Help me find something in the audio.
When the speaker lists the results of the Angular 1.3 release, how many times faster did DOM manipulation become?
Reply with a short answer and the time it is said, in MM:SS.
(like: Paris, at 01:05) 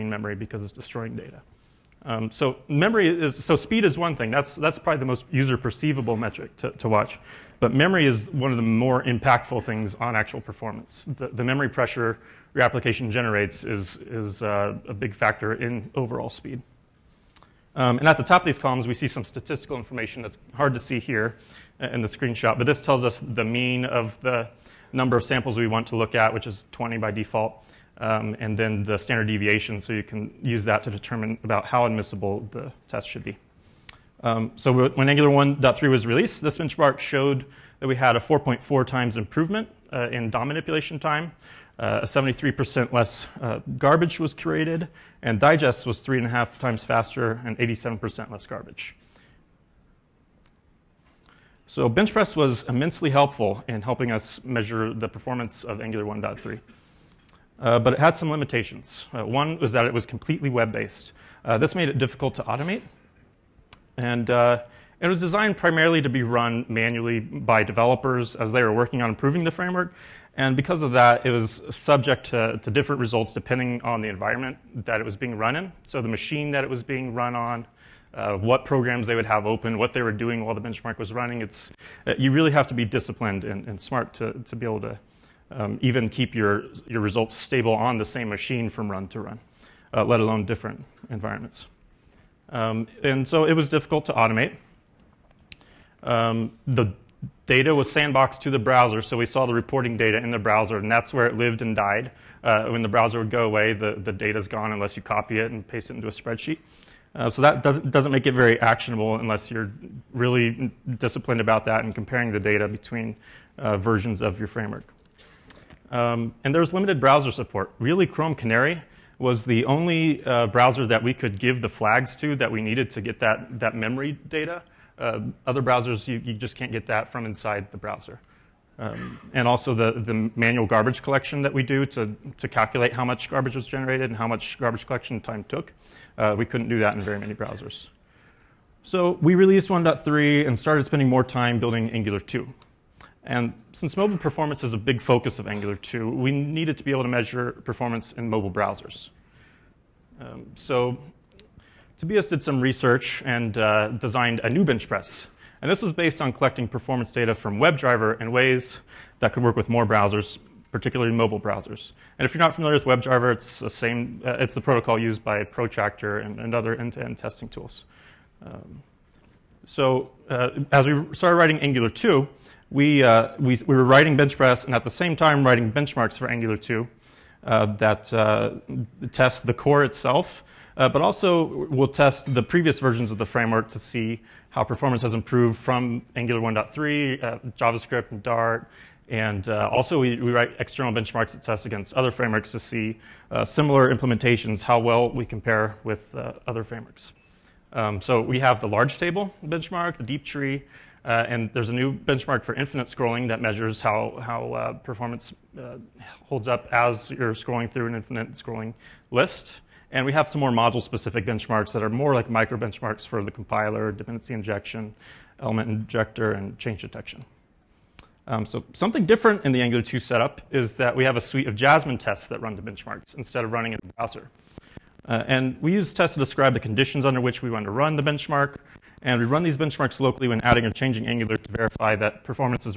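4.4 times, at 00:38.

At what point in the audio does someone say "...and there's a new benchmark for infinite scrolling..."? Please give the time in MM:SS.
03:21.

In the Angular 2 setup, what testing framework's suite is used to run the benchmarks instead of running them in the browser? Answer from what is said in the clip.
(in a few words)
Jasmine.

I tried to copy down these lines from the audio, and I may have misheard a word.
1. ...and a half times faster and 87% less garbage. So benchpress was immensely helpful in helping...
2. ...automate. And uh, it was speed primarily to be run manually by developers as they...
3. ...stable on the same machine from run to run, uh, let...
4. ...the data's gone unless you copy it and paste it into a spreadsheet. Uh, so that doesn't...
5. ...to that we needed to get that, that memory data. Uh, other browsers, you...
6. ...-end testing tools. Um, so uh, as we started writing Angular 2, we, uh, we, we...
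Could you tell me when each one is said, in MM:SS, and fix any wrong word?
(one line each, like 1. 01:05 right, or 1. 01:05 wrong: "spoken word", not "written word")
1. 00:46 right
2. 01:02 wrong: "designed", not "speed"
3. 01:27 right
4. 01:44 right
5. 02:02 right
6. 02:47 right.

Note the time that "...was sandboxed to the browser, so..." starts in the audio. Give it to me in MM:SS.
01:37.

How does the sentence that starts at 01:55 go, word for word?
Um, and there's limited browser support.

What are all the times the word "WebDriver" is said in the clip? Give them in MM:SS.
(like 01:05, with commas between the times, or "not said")
02:37, 02:42.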